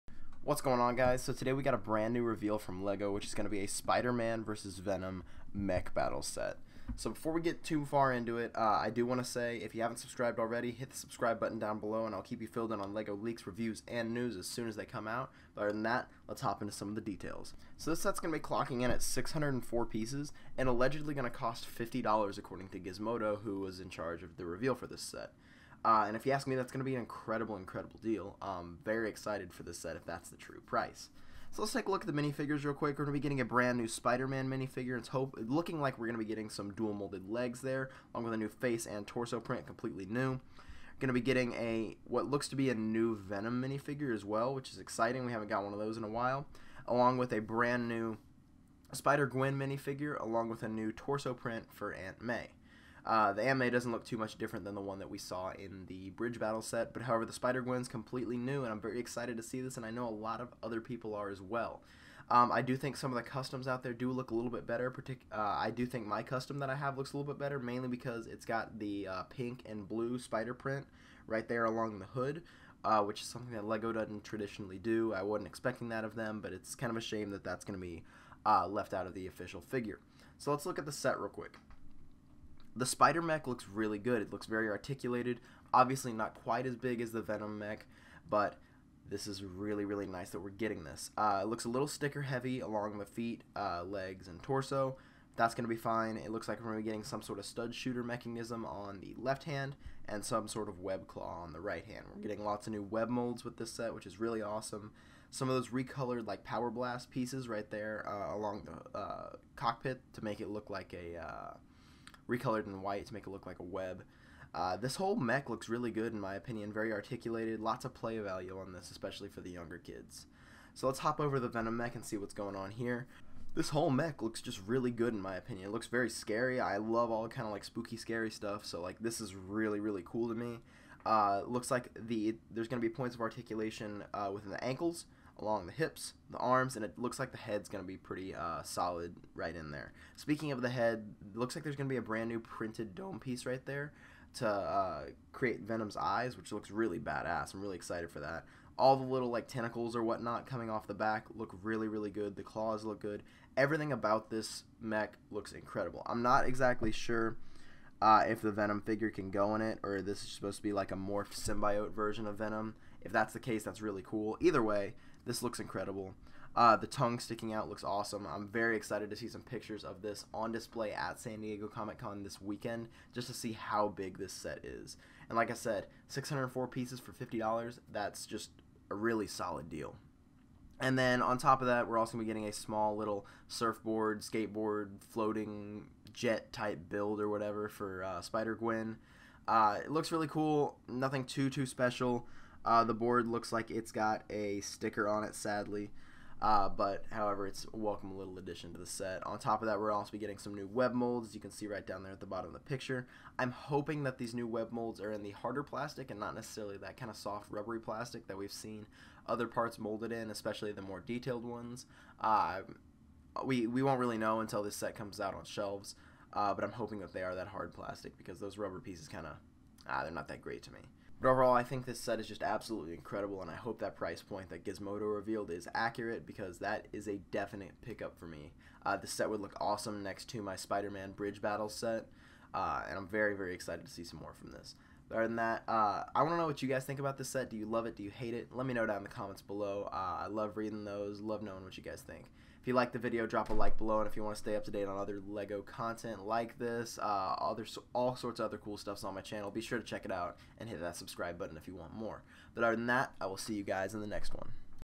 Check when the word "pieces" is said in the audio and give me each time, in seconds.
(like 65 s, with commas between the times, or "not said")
19 s, 107 s, 143 s, 176 s, 218 s.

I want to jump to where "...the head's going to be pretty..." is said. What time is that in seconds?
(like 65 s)
137 s.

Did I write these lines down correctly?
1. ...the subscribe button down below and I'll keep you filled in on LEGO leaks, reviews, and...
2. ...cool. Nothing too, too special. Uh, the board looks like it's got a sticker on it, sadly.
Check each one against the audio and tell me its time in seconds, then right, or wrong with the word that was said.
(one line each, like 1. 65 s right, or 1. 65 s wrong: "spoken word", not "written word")
1. 10 s right
2. 190 s right.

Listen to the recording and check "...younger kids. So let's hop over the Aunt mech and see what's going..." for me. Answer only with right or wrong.
wrong.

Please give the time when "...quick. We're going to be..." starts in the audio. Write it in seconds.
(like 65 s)
32 s.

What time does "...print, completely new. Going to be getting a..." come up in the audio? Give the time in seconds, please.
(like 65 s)
39 s.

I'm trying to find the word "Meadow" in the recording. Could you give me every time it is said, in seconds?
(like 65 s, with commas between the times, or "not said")
not said.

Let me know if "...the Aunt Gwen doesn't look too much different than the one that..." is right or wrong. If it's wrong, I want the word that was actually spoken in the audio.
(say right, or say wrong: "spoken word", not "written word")
wrong: "May", not "Gwen".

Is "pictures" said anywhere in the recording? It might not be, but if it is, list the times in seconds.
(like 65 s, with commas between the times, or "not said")
169 s, 202 s.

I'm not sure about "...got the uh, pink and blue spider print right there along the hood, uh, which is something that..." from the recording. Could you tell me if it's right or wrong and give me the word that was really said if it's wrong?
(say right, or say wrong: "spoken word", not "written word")
right.